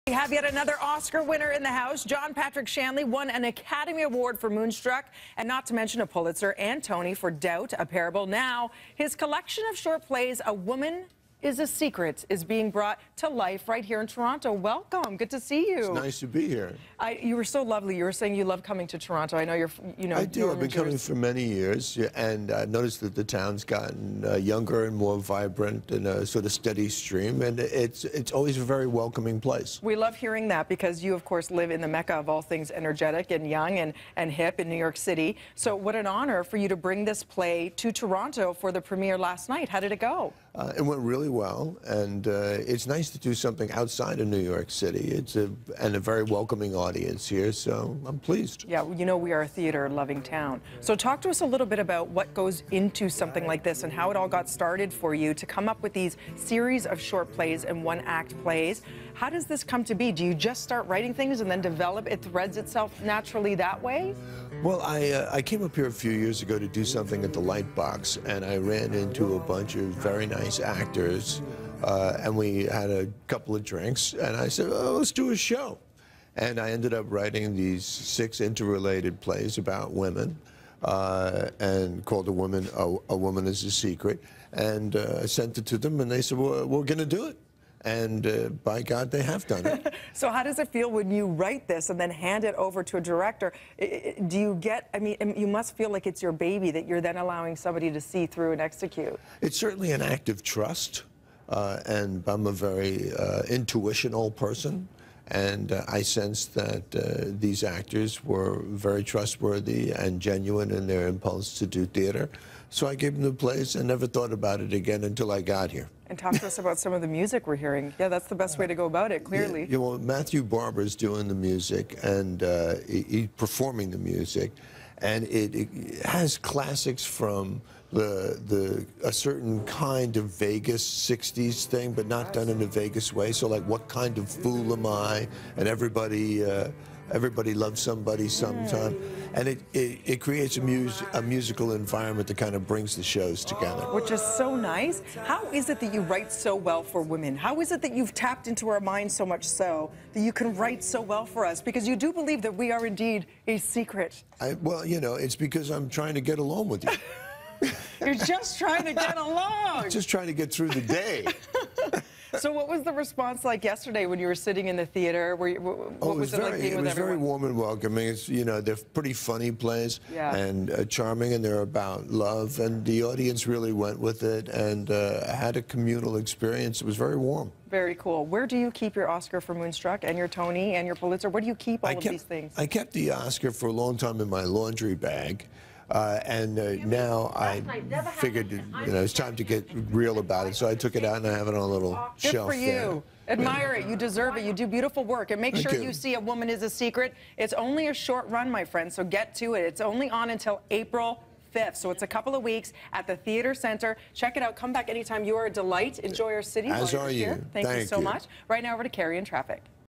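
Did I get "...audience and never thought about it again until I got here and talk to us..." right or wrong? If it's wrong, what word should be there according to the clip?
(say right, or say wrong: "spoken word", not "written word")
wrong: "place", not "audience".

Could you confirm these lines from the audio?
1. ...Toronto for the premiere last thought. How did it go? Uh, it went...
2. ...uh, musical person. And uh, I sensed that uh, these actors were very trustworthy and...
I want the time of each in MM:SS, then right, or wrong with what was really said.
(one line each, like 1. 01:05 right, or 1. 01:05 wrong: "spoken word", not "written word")
1. 00:37 wrong: "night", not "thought"
2. 01:43 wrong: "intuitional", not "musical".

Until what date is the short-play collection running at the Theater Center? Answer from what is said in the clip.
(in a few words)
April 5th.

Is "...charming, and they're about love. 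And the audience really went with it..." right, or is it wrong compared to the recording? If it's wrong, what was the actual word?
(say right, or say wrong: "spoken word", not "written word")
right.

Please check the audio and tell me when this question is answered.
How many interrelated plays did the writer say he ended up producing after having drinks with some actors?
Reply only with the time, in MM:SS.
01:17.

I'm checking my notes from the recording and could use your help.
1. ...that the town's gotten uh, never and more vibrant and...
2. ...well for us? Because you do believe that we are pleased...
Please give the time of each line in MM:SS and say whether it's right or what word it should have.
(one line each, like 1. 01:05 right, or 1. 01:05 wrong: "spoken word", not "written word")
1. 00:23 wrong: "younger", not "never"
2. 02:31 wrong: "indeed", not "pleased".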